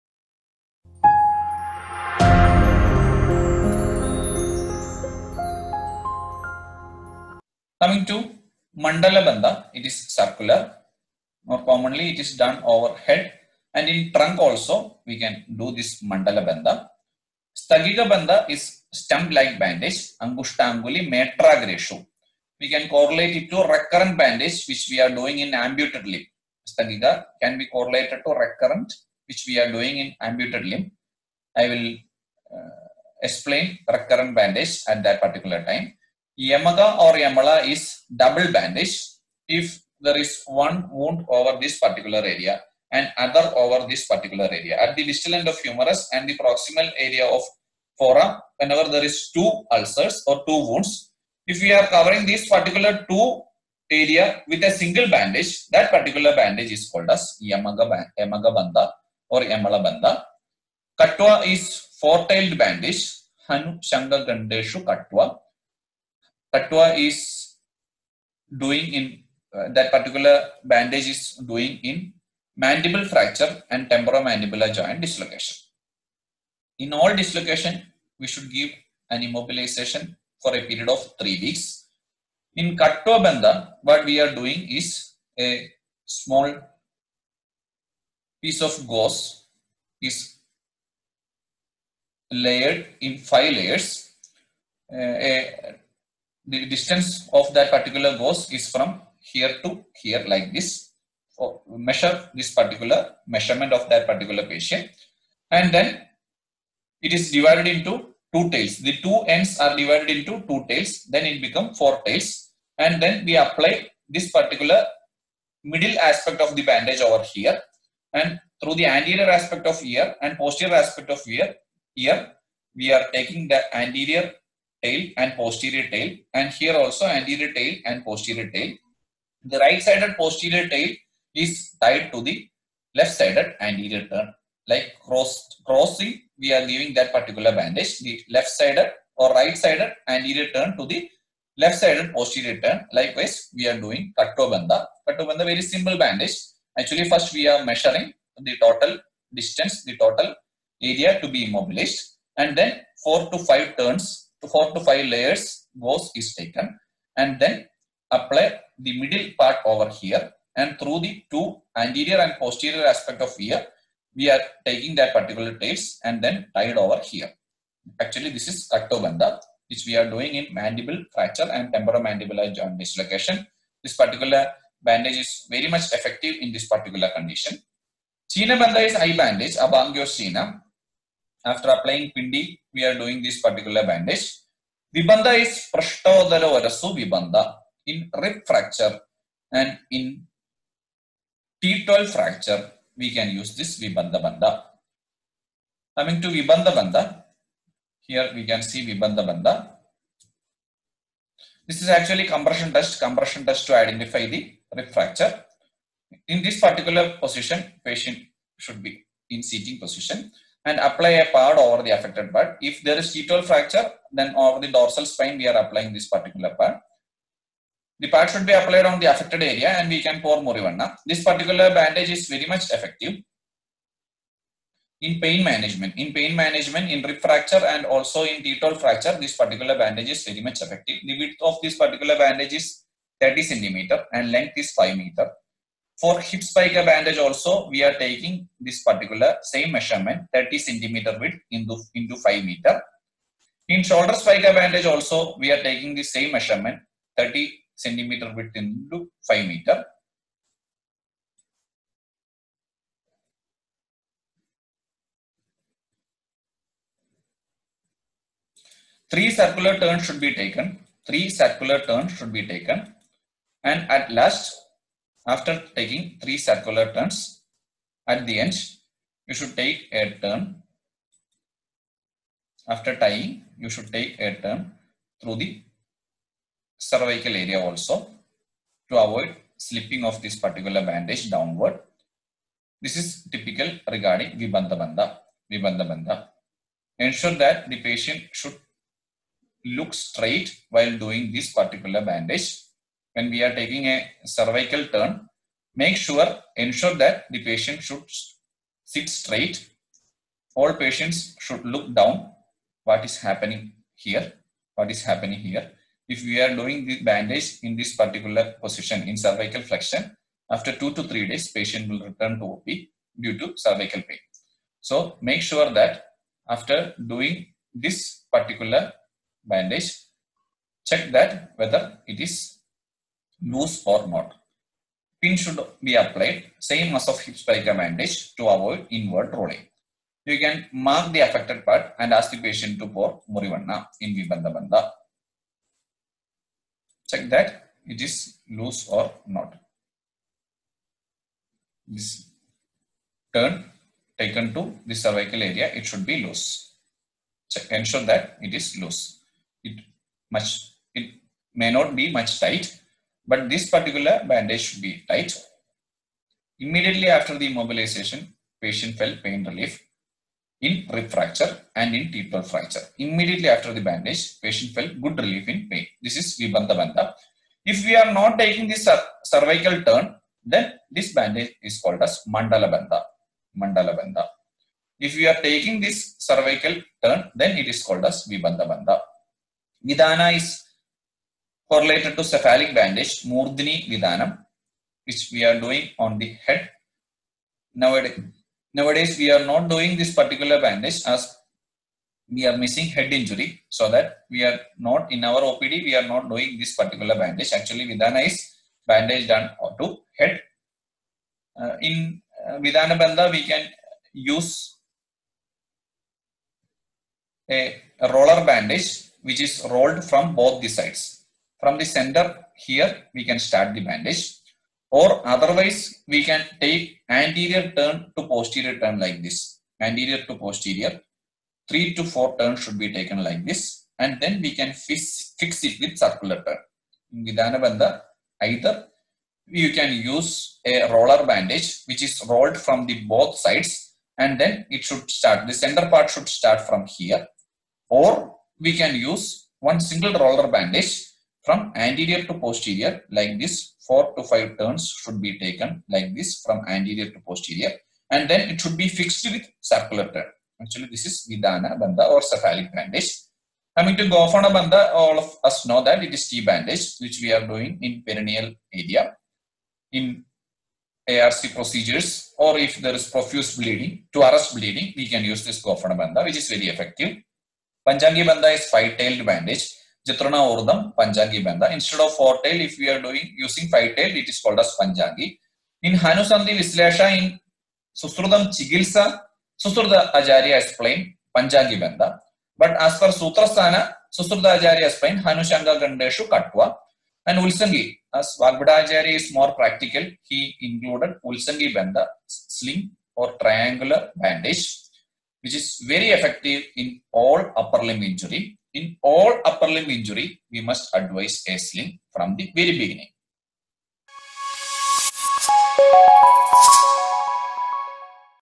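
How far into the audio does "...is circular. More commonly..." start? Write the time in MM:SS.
00:09.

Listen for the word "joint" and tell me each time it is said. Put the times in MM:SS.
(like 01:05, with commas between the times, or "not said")
01:14, 02:52.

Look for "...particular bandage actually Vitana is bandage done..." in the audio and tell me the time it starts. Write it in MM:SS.
06:36.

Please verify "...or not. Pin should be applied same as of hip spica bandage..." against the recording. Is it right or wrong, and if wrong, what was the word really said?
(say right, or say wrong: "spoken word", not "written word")
right.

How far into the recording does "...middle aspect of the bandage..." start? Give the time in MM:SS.
01:55.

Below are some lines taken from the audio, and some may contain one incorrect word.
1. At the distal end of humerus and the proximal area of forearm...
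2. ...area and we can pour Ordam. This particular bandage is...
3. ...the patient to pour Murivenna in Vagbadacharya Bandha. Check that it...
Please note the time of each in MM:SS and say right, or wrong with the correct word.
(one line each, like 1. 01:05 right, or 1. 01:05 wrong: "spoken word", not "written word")
1. 00:44 right
2. 03:39 wrong: "Murivenna", not "Ordam"
3. 05:32 wrong: "Vibandha", not "Vagbadacharya".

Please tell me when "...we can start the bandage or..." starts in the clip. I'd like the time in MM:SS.
06:53.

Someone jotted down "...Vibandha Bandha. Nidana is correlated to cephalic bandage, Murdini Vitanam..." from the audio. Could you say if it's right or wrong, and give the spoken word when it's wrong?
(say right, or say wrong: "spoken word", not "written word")
right.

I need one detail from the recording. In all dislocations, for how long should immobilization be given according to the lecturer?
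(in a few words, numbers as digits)
3 weeks.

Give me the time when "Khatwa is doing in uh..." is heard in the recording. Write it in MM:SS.
01:06.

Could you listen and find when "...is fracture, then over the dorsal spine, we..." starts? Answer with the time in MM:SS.
03:32.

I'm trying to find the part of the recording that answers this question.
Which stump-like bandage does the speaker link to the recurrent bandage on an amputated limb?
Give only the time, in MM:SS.
00:17.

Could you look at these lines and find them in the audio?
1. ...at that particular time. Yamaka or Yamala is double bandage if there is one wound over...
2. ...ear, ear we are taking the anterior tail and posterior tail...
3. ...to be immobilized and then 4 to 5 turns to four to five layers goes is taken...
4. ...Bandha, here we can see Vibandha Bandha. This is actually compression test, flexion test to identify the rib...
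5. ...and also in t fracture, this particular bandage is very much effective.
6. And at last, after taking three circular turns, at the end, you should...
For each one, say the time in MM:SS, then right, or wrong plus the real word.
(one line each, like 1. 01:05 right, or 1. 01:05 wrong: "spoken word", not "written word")
1. 00:34 right
2. 02:01 right
3. 02:31 right
4. 03:16 wrong: "compression", not "flexion"
5. 03:47 right
6. 04:23 right.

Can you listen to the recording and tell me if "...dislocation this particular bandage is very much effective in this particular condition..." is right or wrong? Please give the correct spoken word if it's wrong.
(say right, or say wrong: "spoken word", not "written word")
right.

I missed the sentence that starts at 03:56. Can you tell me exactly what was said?
For hip spica bandage also, we are taking this particular same measurement, 30 centimeter width into, into 5 meter.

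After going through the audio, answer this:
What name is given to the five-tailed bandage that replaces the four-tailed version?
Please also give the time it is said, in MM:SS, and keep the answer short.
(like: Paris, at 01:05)
Panchangi Bandha, at 07:47.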